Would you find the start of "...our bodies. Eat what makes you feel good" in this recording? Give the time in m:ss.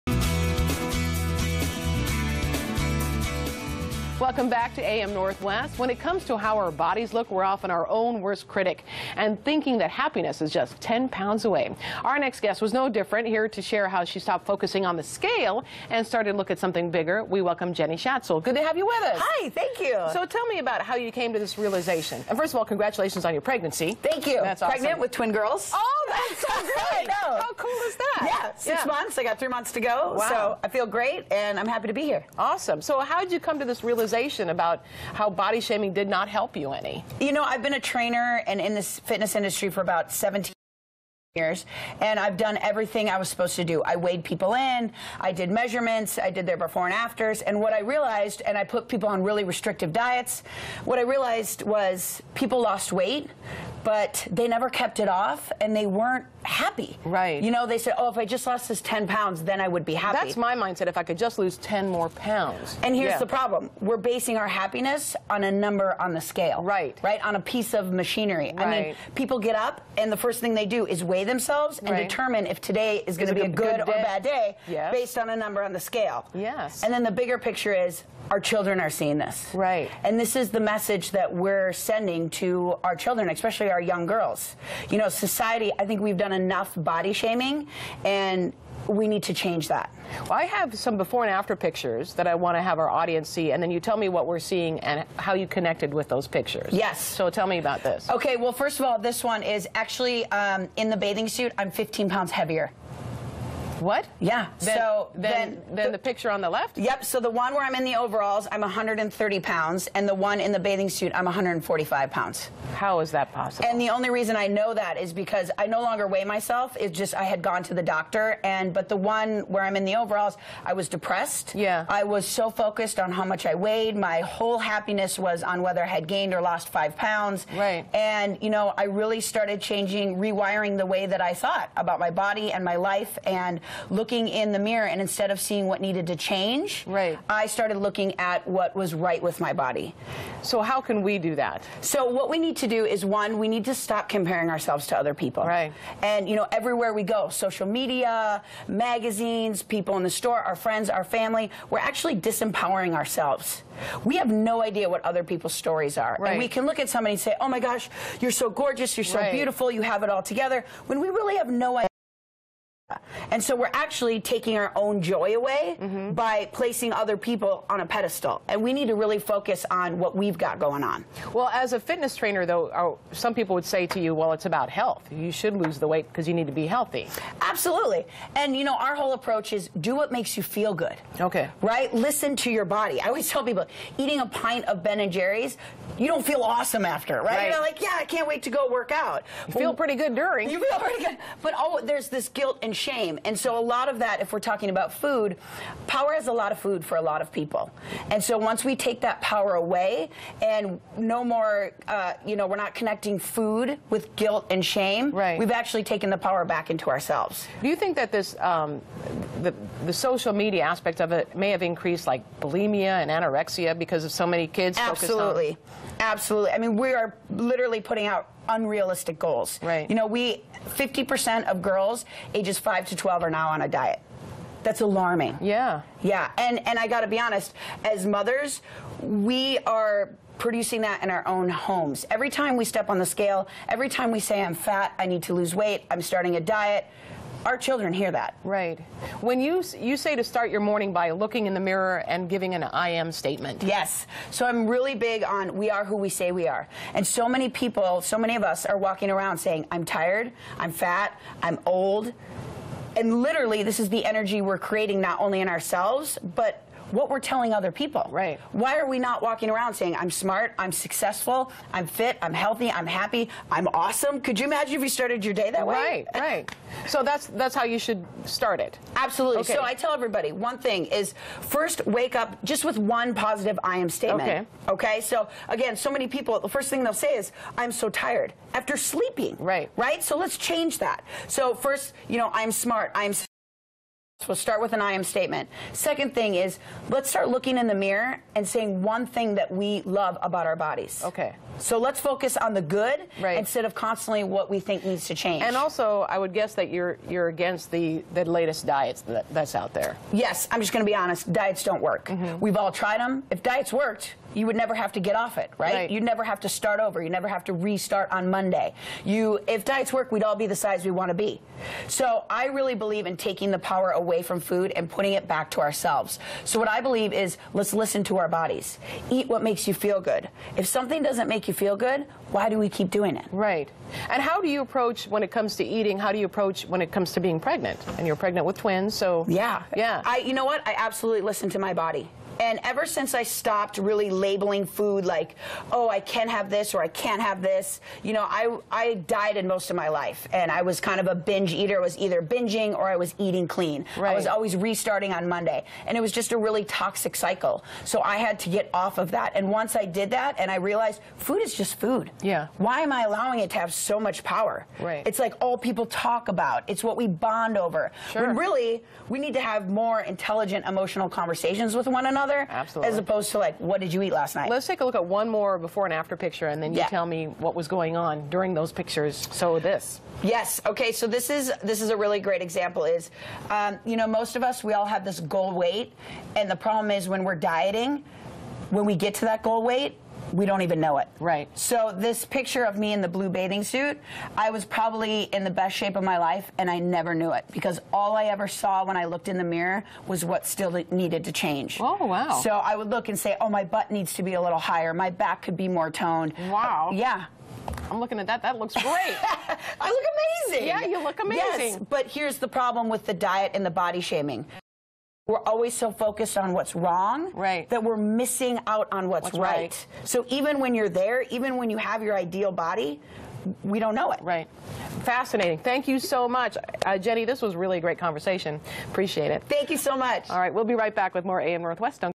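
5:18.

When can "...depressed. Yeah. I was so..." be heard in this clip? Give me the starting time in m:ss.
2:00.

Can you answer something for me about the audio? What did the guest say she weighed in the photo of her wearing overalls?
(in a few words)
130 pounds.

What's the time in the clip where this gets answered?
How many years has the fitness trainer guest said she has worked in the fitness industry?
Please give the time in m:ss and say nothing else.
0:40.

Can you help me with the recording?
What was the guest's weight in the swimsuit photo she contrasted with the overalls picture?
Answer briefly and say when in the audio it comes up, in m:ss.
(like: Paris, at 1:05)
145 pounds, at 1:51.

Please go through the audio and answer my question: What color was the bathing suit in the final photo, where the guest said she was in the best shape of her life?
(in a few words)
Blue.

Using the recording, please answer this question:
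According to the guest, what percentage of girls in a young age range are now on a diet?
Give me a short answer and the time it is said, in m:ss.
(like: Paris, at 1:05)
50%, at 3:40.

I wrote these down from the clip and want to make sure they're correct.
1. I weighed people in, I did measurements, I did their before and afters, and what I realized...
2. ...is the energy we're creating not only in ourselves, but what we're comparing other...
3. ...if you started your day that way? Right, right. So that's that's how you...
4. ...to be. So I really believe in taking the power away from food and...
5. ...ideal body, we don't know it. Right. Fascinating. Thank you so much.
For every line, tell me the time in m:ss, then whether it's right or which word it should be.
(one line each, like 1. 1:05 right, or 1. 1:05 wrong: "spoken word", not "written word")
1. 0:43 right
2. 4:13 wrong: "telling", not "comparing"
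3. 4:24 right
4. 5:11 right
5. 6:52 right.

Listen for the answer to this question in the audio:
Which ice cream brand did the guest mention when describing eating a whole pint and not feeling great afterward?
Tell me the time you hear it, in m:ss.
3:04.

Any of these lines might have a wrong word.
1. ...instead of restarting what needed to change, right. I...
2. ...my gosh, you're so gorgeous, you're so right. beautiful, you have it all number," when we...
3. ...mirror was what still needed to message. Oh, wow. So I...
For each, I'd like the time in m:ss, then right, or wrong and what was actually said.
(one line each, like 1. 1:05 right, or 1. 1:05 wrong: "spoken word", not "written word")
1. 2:15 wrong: "seeing", not "restarting"
2. 2:37 wrong: "together", not "number"
3. 6:29 wrong: "change", not "message".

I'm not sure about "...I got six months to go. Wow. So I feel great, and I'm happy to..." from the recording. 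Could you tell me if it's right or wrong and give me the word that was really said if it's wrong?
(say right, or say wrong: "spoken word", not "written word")
wrong: "three", not "six".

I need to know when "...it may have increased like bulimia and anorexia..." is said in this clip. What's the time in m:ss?
3:31.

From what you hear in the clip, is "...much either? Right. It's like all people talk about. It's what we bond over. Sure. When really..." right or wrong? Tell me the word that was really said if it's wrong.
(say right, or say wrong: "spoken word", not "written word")
wrong: "power", not "either".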